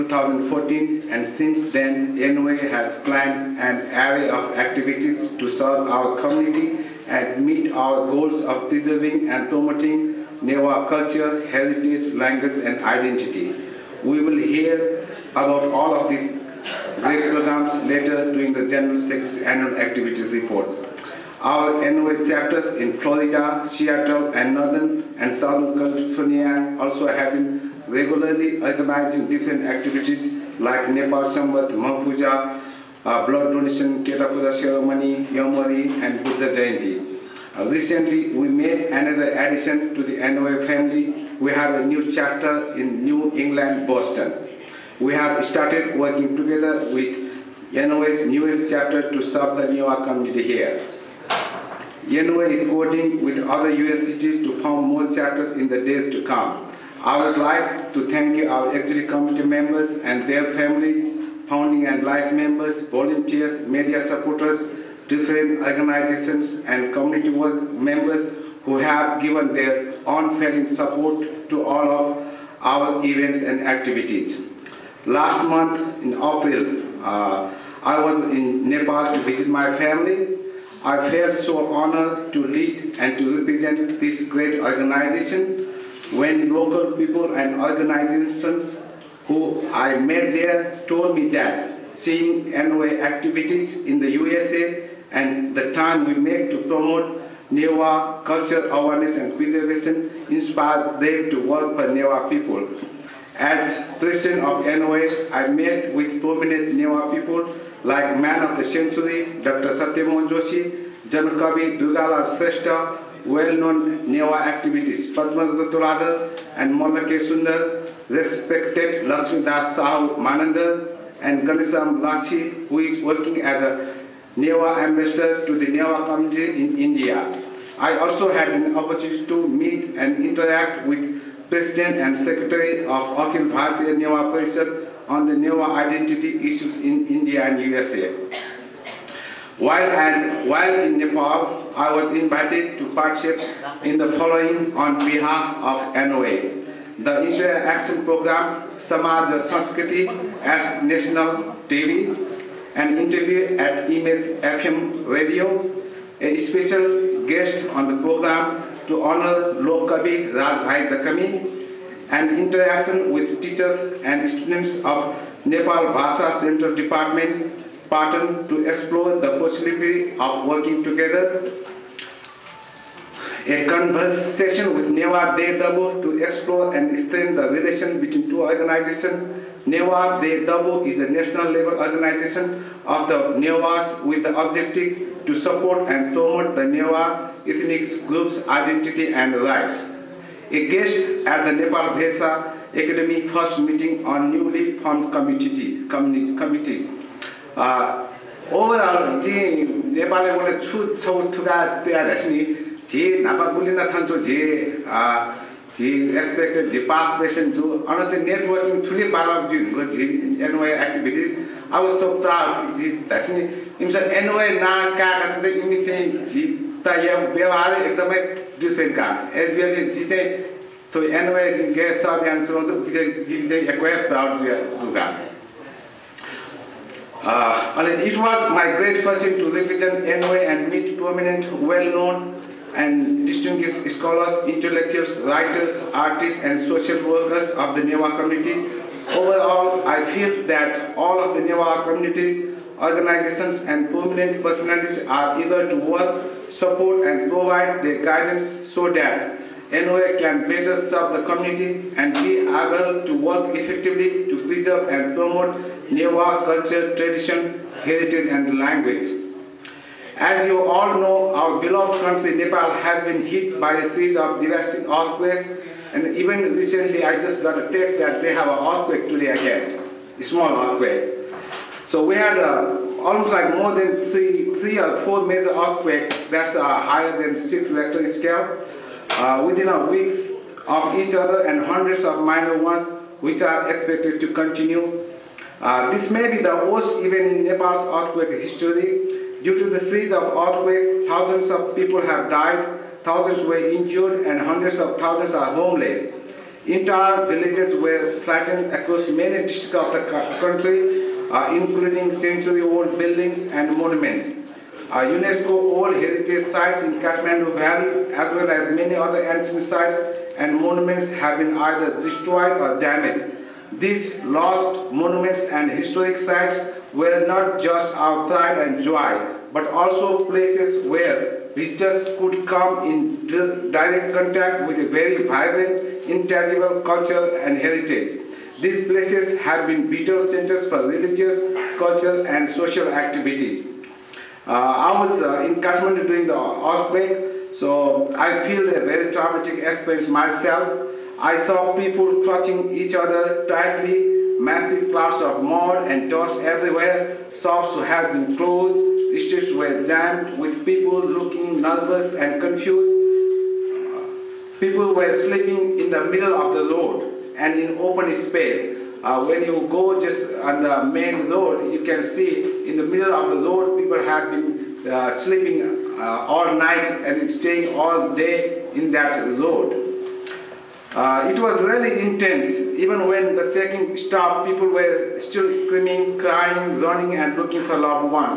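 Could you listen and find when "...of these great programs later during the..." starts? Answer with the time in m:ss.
0:15.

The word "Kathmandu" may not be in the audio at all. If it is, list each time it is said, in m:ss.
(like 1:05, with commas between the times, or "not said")
5:06, 5:35.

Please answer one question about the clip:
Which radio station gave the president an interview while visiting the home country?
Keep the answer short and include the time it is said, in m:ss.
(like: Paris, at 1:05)
Image FM Radio, at 2:33.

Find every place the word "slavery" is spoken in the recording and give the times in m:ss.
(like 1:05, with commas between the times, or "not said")
not said.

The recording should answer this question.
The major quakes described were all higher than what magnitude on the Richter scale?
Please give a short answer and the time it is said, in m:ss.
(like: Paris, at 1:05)
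6, at 4:37.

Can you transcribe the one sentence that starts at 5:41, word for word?
I saw people clutching each other tightly Massive clouds of mud and dust everywhere.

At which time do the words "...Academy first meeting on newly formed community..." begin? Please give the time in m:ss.
3:12.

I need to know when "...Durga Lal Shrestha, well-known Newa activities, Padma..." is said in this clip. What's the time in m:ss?
1:51.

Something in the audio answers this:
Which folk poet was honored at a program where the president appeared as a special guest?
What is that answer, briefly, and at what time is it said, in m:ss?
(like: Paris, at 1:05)
Rajbhai Jakami, at 2:40.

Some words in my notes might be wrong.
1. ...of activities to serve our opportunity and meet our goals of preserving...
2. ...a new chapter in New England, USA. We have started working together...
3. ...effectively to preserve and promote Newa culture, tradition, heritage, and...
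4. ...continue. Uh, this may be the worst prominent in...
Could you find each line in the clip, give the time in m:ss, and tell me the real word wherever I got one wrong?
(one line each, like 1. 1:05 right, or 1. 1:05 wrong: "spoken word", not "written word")
1. 0:04 wrong: "community", not "opportunity"
2. 0:41 wrong: "Boston", not "USA"
3. 4:13 right
4. 4:44 wrong: "event", not "prominent".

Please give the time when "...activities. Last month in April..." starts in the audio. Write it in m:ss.
1:13.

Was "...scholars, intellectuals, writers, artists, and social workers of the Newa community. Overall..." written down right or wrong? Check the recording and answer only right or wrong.
right.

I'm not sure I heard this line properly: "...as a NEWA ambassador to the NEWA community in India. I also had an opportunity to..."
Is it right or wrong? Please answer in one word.
right.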